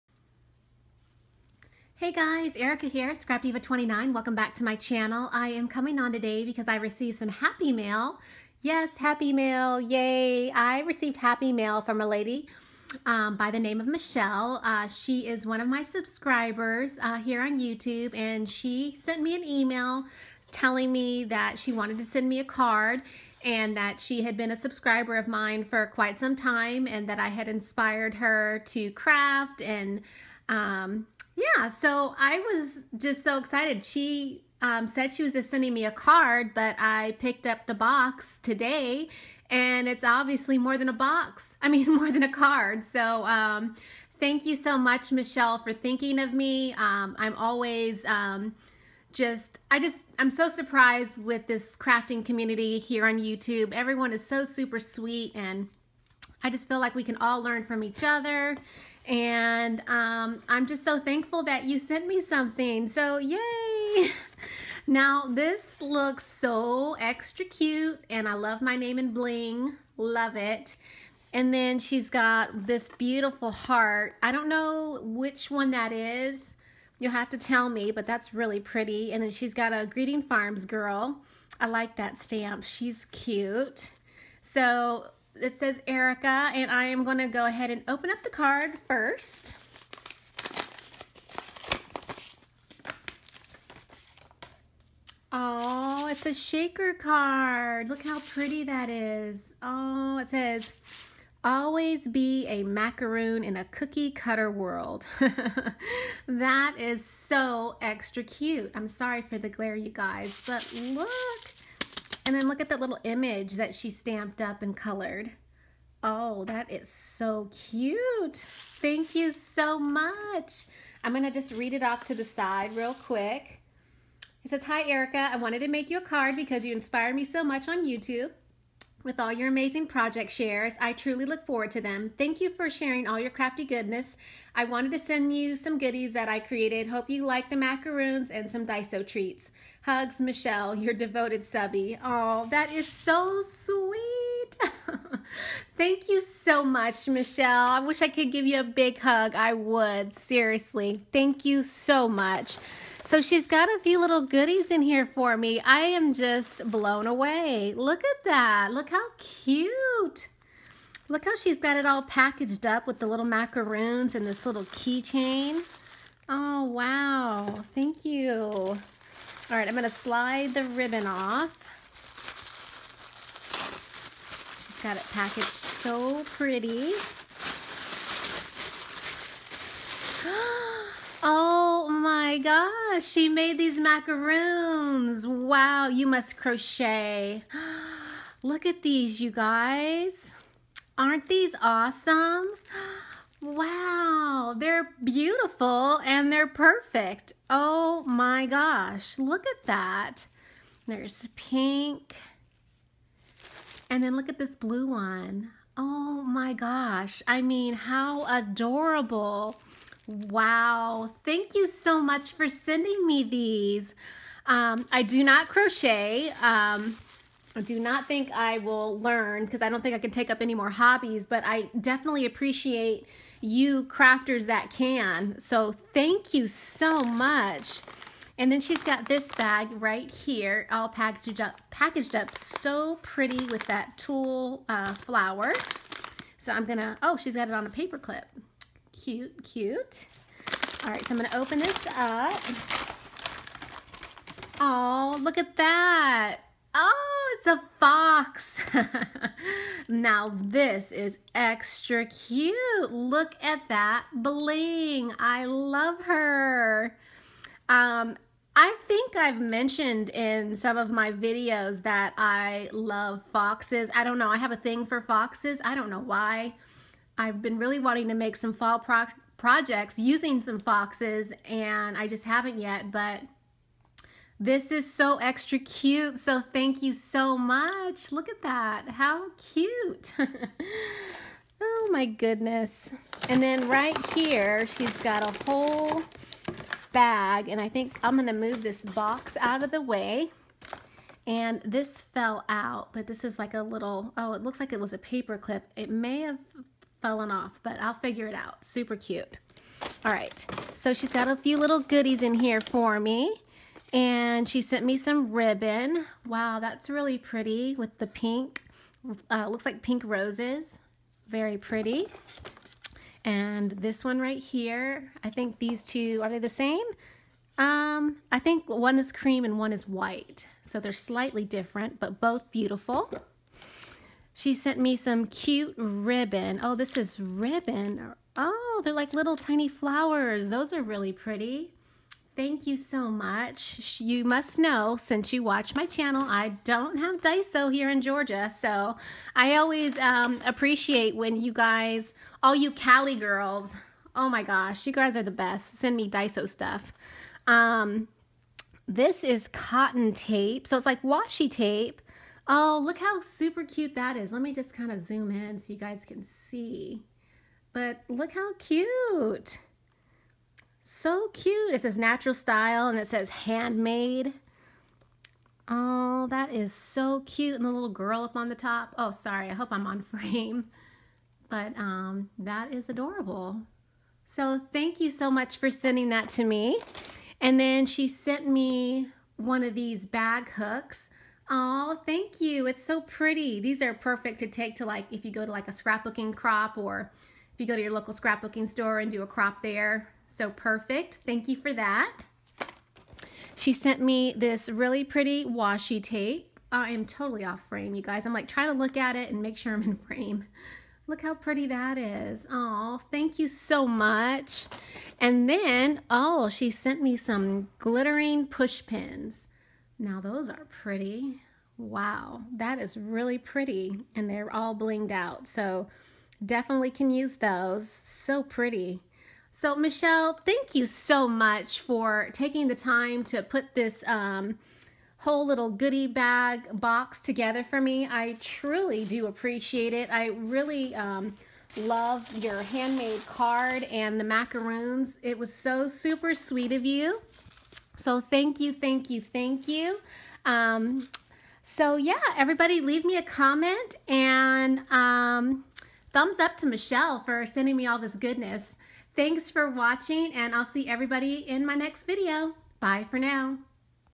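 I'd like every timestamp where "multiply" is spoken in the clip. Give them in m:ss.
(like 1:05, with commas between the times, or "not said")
not said.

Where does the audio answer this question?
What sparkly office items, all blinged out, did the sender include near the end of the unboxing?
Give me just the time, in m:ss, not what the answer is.
6:47.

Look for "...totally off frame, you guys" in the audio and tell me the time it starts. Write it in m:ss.
6:37.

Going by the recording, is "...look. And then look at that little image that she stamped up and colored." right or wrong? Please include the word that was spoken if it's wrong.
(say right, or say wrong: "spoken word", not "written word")
right.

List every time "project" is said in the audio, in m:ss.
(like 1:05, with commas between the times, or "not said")
2:09, 4:29.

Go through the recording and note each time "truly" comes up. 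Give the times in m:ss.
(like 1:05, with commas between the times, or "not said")
2:10, 7:08.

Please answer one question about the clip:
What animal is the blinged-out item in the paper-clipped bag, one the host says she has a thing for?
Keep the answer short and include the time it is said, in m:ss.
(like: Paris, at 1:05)
Fox, at 4:07.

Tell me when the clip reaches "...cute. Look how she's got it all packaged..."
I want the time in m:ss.
2:39.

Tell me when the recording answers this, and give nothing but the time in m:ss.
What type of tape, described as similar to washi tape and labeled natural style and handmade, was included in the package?
5:49.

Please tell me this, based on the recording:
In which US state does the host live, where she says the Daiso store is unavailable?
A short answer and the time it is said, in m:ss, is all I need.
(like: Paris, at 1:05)
Georgia, at 5:38.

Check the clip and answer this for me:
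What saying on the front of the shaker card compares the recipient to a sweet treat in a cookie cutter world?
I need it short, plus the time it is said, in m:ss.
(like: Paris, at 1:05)
Always be a macaroon, at 1:41.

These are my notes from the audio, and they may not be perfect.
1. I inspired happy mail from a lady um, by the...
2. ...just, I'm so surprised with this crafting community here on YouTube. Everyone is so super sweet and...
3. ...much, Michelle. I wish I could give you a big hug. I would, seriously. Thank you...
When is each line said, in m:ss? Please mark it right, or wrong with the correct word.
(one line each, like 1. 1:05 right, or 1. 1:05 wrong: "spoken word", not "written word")
1. 0:10 wrong: "received", not "inspired"
2. 0:49 right
3. 2:26 right.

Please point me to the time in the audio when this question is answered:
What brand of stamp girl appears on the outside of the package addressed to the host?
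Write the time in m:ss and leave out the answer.
1:19.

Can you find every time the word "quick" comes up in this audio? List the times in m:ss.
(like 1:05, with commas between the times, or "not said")
2:02.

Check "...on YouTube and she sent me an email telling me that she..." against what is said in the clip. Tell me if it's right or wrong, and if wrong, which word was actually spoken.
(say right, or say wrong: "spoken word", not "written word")
right.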